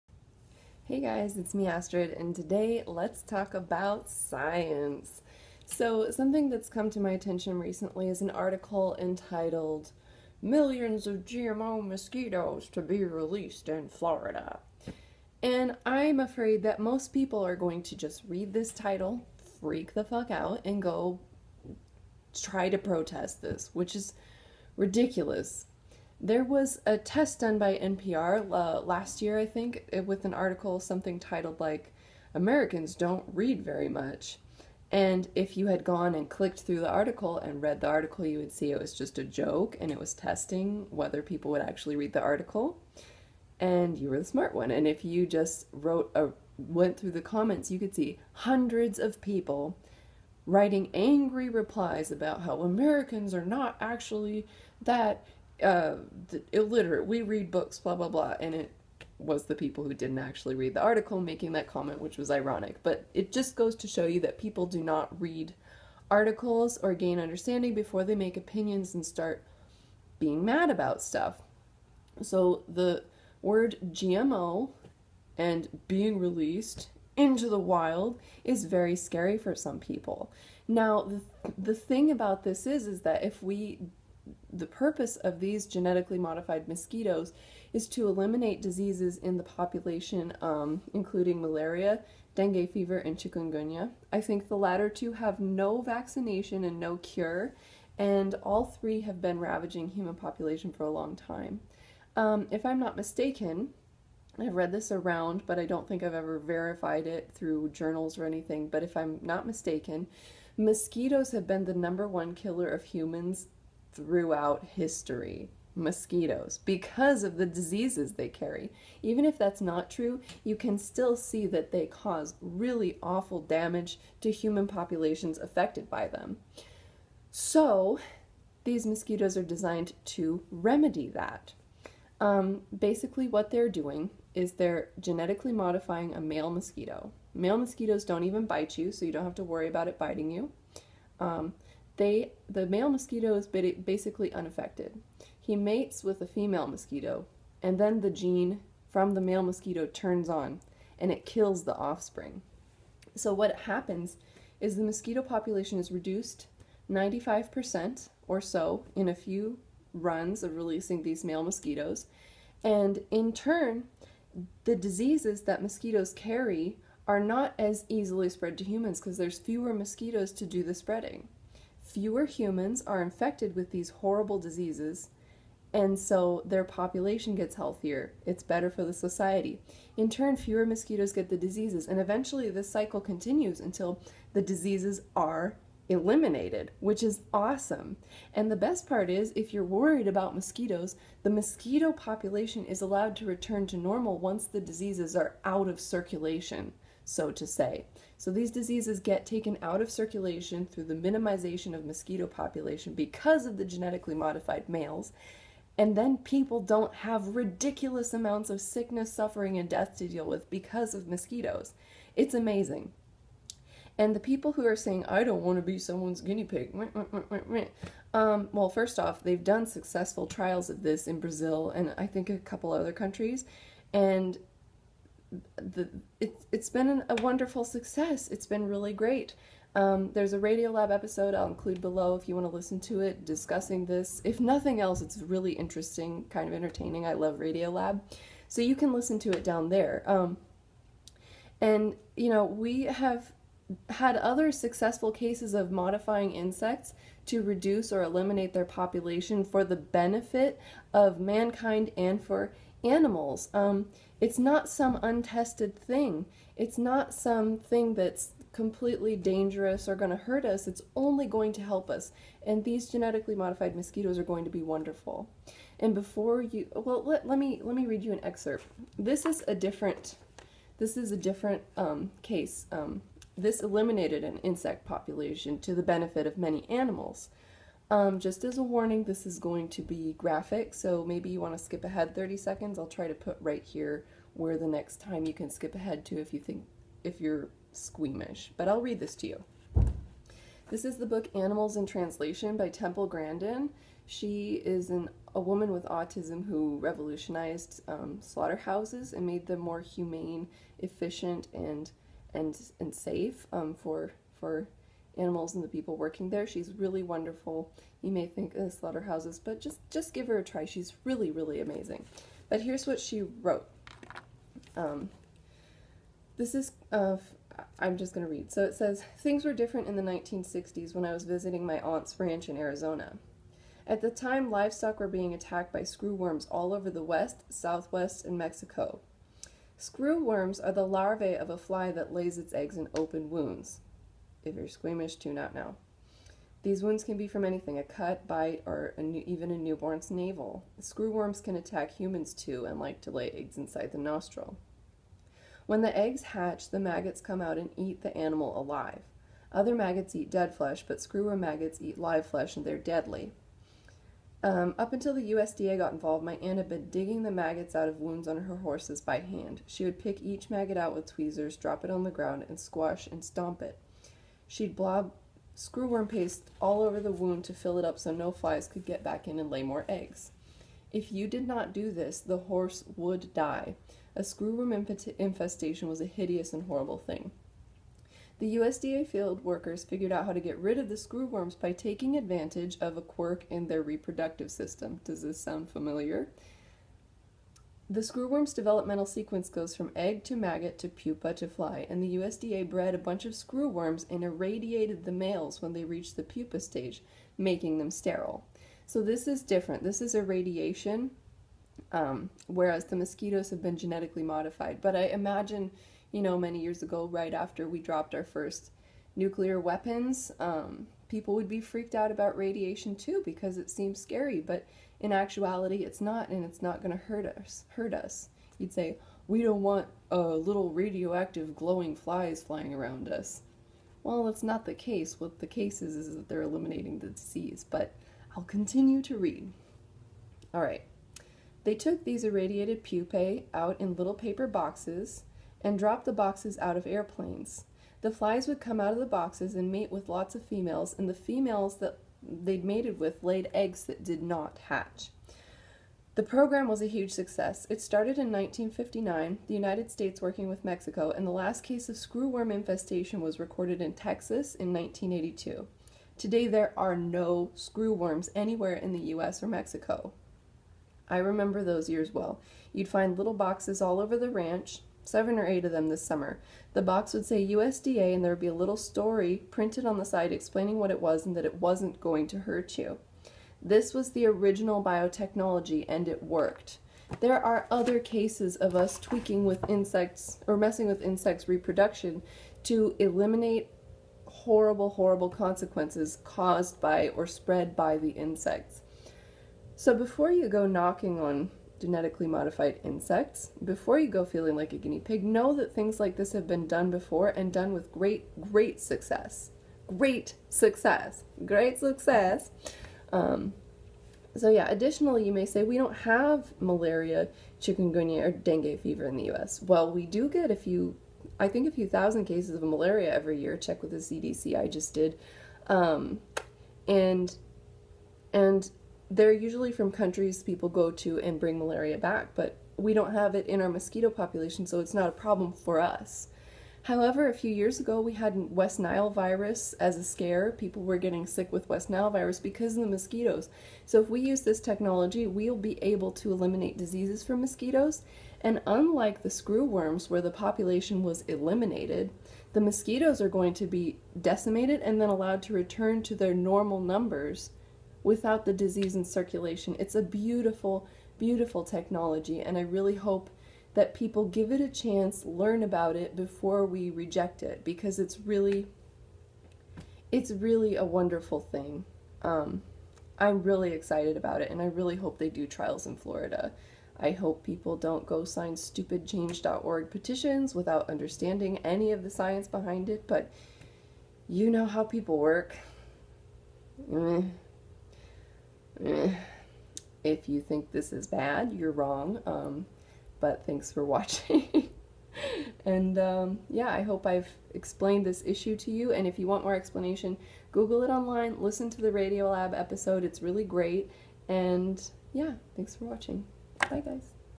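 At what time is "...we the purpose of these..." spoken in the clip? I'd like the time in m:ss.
1:23.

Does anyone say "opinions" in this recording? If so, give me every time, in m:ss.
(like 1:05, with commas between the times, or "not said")
1:08.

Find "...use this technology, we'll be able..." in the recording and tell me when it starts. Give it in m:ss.
8:54.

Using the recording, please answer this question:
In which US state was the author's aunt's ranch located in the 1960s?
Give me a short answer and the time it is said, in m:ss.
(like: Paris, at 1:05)
Arizona, at 5:22.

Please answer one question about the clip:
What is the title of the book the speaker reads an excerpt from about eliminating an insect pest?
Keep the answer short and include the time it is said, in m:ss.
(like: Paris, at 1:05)
Animals in Translation, at 4:51.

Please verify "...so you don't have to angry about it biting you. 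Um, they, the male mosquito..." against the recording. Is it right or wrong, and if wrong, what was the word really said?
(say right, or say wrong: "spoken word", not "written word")
wrong: "worry", not "angry".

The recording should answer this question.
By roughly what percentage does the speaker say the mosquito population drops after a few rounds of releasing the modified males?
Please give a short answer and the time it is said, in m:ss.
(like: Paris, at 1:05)
95%, at 2:36.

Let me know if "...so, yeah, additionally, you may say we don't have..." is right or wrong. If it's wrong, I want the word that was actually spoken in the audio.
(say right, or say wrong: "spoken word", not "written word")
right.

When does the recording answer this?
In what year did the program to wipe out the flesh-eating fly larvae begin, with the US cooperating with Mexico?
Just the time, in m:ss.
7:28.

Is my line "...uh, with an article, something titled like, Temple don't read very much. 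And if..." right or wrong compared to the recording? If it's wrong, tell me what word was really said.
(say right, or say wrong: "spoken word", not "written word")
wrong: "Americans", not "Temple".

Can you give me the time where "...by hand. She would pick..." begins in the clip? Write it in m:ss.
5:59.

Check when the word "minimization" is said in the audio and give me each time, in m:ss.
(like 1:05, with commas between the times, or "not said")
3:20.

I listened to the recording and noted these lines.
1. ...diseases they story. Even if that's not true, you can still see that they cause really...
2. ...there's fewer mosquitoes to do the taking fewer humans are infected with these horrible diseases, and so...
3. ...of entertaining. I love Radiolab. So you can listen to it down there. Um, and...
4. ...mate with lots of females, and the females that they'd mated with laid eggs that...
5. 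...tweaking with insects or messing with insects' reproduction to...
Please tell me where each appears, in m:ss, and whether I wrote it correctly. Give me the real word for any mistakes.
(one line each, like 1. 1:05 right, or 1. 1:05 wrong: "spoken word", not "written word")
1. 1:57 wrong: "carry", not "story"
2. 2:49 wrong: "spreading", not "taking"
3. 3:56 right
4. 7:19 right
5. 7:58 right.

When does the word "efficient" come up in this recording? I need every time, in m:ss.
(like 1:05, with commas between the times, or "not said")
5:00.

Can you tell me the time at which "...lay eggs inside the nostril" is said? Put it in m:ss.
5:43.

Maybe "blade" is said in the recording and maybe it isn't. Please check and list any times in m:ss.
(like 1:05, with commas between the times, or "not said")
not said.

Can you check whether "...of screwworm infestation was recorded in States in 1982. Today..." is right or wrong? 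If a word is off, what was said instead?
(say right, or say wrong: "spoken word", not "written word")
wrong: "Texas", not "States".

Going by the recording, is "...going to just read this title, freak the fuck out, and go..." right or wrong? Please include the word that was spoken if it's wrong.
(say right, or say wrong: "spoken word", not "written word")
right.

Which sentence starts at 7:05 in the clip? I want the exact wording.
What the case is is that they're eliminating the disease, but I'll continue to read.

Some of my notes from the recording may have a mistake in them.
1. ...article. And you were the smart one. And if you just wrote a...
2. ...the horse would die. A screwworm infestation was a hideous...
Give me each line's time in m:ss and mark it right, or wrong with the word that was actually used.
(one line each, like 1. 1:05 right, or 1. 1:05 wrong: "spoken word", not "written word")
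1. 0:42 right
2. 6:12 right.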